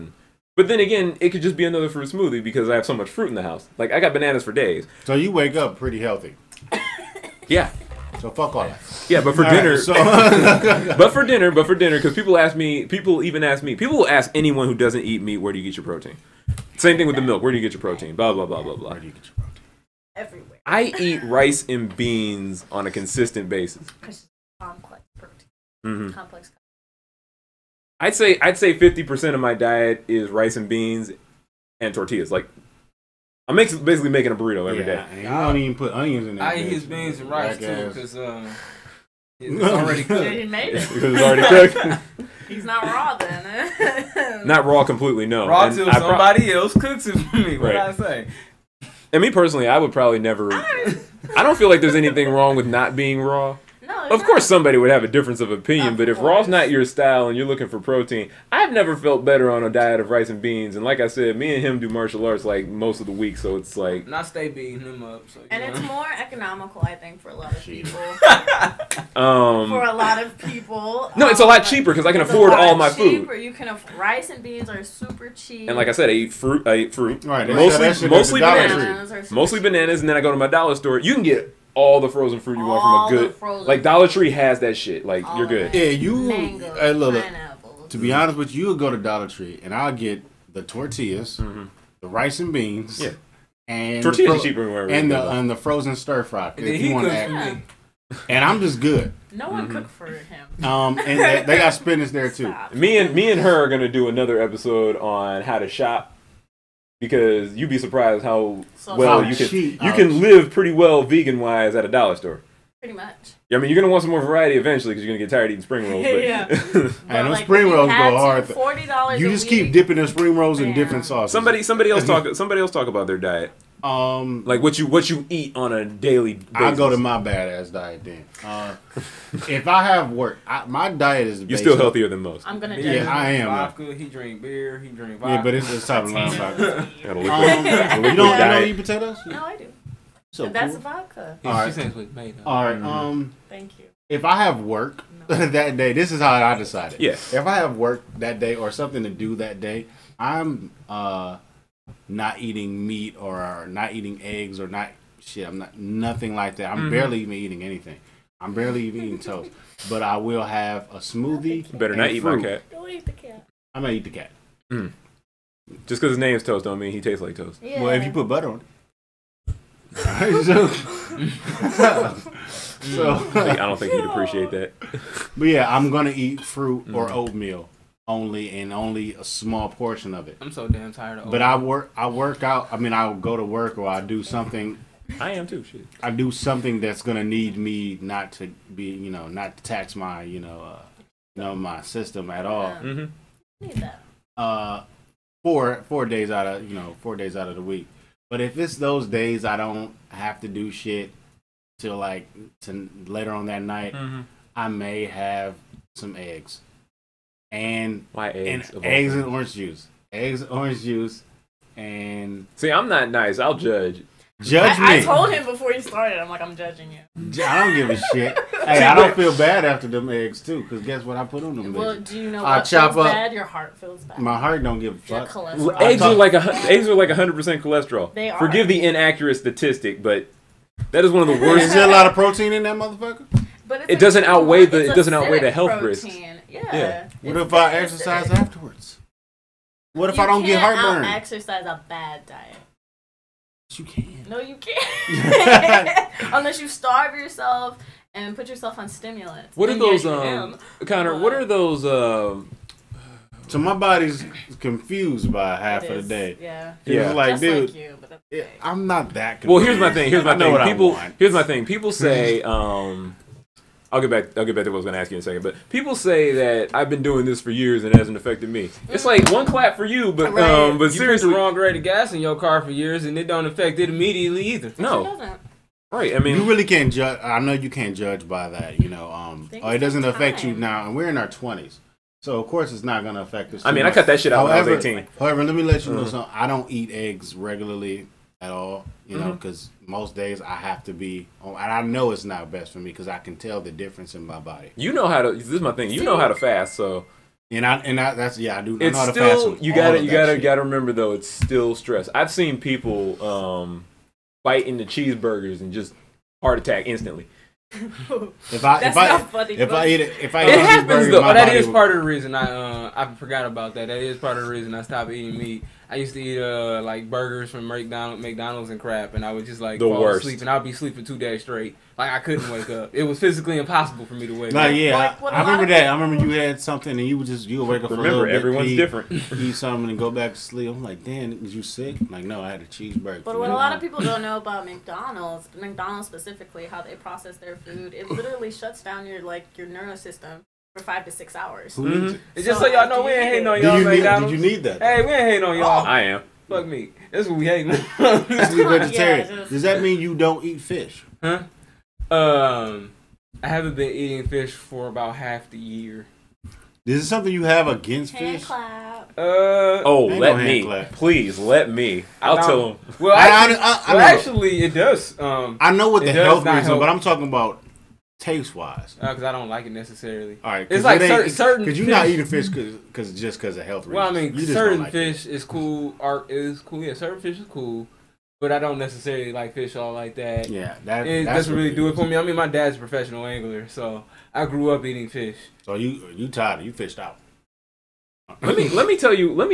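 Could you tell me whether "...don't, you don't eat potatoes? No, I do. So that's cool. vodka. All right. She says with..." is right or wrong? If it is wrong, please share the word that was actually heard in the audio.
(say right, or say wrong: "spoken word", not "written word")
right.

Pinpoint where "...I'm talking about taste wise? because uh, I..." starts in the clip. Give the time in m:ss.
6:06.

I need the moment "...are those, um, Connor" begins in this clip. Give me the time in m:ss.
4:09.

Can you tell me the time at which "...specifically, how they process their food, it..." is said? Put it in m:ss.
5:36.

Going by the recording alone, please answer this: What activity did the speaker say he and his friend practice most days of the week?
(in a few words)
Martial arts.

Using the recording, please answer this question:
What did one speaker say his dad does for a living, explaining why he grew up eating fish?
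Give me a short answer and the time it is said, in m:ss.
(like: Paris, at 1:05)
Professional angler, at 6:22.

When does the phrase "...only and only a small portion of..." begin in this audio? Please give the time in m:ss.
2:58.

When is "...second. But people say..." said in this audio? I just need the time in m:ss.
4:25.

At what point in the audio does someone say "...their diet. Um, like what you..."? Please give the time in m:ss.
2:03.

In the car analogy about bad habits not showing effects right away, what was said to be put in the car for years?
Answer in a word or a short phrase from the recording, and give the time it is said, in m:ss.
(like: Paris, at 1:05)
Wrong grade of gas, at 4:31.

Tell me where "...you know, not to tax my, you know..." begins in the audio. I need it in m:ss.
3:08.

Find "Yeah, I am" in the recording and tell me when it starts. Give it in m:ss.
2:12.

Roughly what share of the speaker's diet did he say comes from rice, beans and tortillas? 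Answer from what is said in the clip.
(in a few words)
50 percent.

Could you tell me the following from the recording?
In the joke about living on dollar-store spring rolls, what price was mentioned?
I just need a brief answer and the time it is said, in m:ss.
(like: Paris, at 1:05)
$40, at 1:58.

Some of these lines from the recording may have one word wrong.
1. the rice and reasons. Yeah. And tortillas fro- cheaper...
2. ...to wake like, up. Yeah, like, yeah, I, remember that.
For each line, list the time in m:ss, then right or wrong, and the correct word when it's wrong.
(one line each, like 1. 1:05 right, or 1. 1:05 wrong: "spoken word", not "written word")
1. 1:31 wrong: "beans", not "reasons"
2. 5:24 right.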